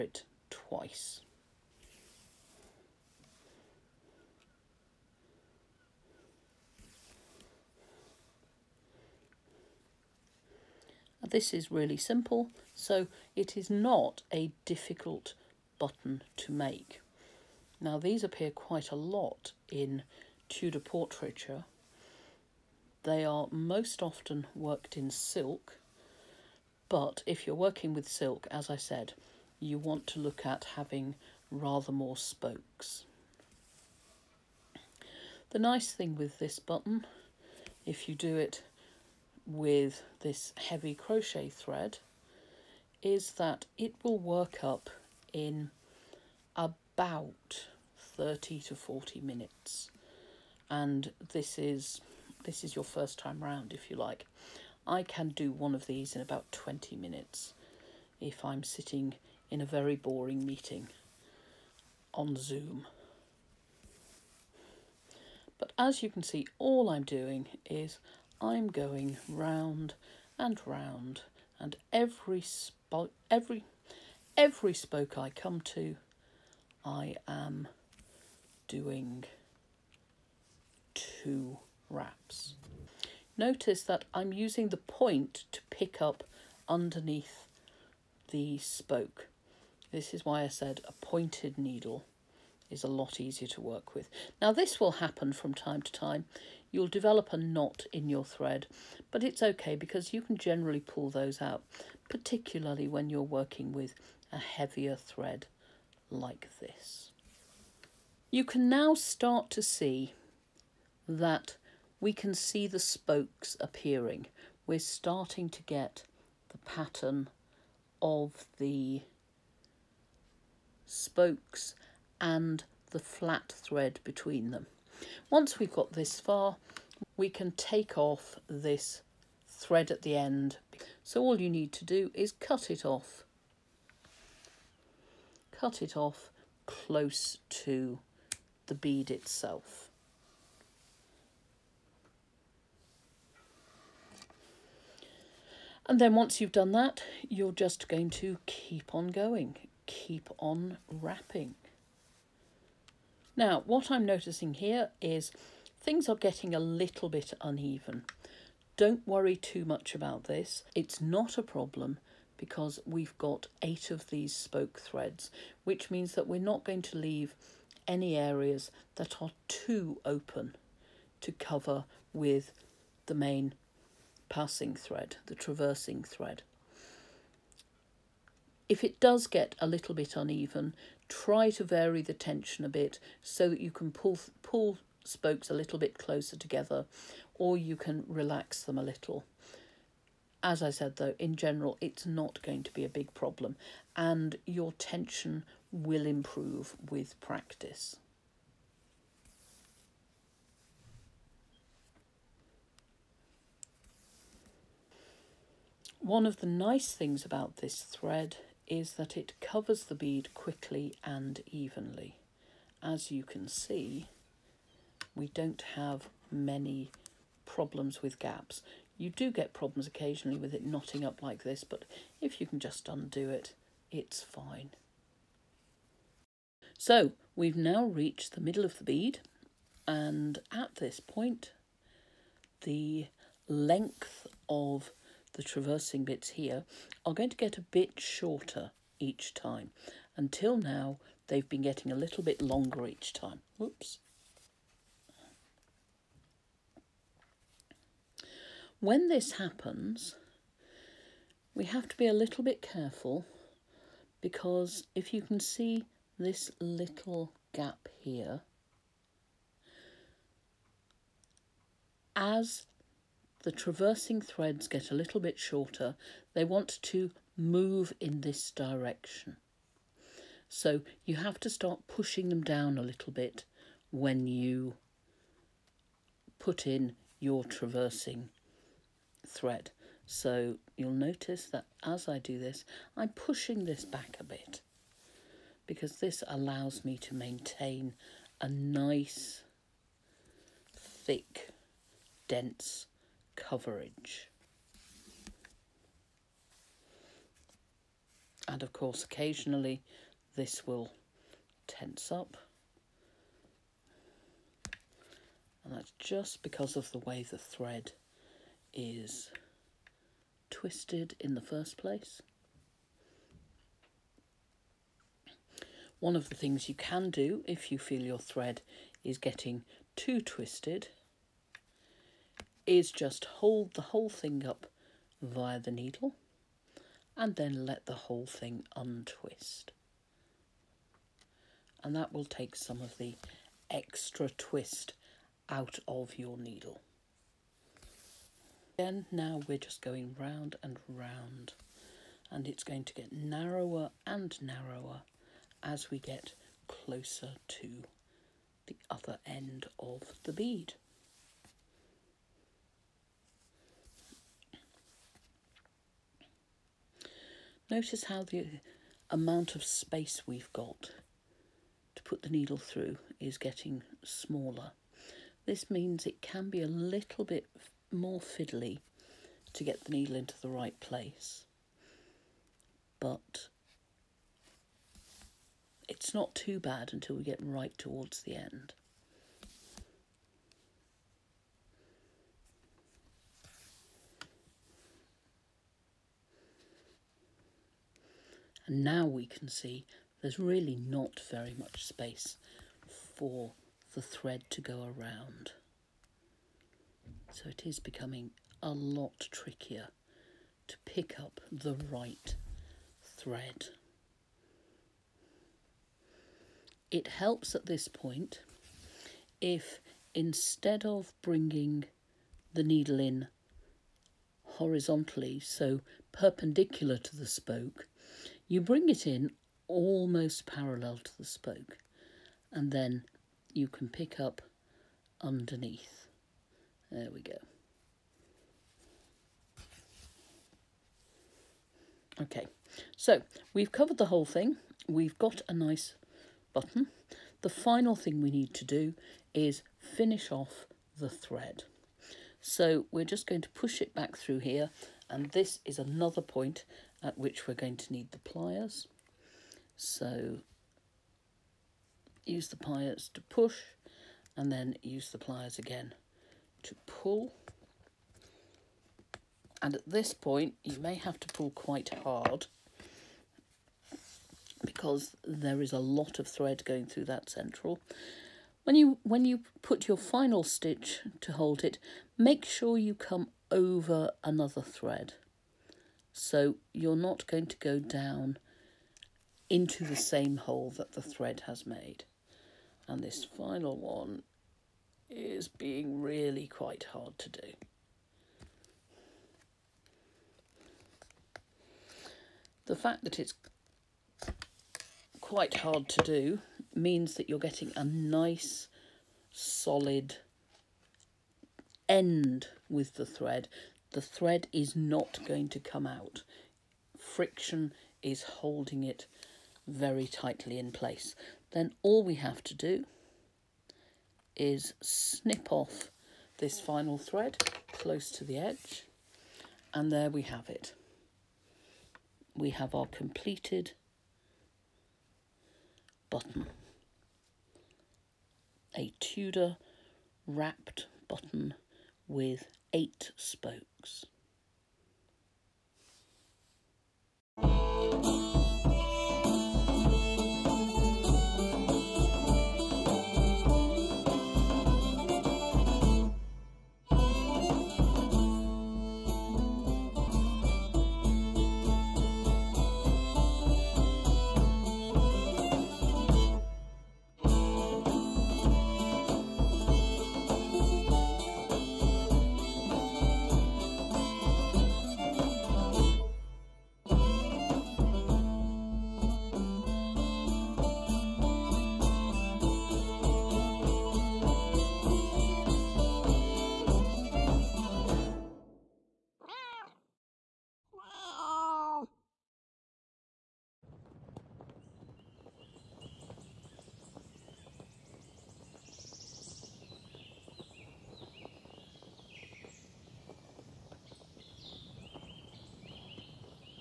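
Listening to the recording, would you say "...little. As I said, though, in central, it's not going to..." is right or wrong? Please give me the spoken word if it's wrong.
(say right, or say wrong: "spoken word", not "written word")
wrong: "general", not "central".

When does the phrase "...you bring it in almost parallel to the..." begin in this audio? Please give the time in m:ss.
6:58.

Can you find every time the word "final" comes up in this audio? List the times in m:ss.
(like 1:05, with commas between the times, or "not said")
7:17, 7:49, 8:03, 8:36.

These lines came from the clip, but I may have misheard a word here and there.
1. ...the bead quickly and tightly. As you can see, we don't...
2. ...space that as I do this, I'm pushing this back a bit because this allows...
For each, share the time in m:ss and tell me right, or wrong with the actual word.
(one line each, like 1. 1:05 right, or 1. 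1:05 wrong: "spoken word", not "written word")
1. 3:29 wrong: "evenly", not "tightly"
2. 4:40 wrong: "notice", not "space".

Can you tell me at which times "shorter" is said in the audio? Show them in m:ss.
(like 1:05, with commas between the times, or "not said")
3:57, 4:25.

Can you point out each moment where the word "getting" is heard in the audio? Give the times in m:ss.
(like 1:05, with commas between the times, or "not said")
2:36, 4:01, 5:19, 6:03, 8:17.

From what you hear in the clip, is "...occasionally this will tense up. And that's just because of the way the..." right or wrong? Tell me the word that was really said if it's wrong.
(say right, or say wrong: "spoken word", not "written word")
right.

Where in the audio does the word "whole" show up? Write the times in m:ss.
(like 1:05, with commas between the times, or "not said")
5:23, 5:27, 7:14.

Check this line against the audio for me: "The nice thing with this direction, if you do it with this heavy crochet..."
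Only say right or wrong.
wrong.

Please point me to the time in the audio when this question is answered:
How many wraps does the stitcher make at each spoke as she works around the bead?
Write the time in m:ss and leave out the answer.
1:20.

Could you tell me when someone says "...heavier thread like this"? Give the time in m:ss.
1:44.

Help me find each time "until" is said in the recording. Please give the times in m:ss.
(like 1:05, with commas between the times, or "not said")
4:00, 6:16.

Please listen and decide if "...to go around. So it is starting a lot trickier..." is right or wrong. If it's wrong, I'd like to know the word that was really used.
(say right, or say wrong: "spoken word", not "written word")
wrong: "becoming", not "starting".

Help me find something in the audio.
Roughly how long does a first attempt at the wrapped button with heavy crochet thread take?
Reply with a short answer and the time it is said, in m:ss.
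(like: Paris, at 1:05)
30 to 40 minutes, at 0:48.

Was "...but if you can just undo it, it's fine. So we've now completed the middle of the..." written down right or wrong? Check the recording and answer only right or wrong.
wrong.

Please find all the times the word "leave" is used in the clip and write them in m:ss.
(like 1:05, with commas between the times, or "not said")
2:46.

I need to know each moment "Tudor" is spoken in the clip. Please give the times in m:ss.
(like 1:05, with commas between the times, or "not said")
0:20, 8:48.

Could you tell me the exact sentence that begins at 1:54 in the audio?
We're starting to get the pattern of the spokes and the flat thread between them.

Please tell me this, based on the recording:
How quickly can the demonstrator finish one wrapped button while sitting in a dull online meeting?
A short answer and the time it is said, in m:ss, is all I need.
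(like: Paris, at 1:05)
20 minutes, at 0:56.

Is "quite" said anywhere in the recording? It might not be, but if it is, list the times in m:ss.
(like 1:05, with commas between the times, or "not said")
0:18, 7:41, 8:06, 8:15.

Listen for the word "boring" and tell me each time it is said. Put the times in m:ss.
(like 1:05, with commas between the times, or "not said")
0:59.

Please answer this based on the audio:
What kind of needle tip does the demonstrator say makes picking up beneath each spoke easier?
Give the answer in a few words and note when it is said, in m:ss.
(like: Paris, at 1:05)
Pointed, at 1:30.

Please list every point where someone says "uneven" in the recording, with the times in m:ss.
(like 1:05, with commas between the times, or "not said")
2:37, 3:00.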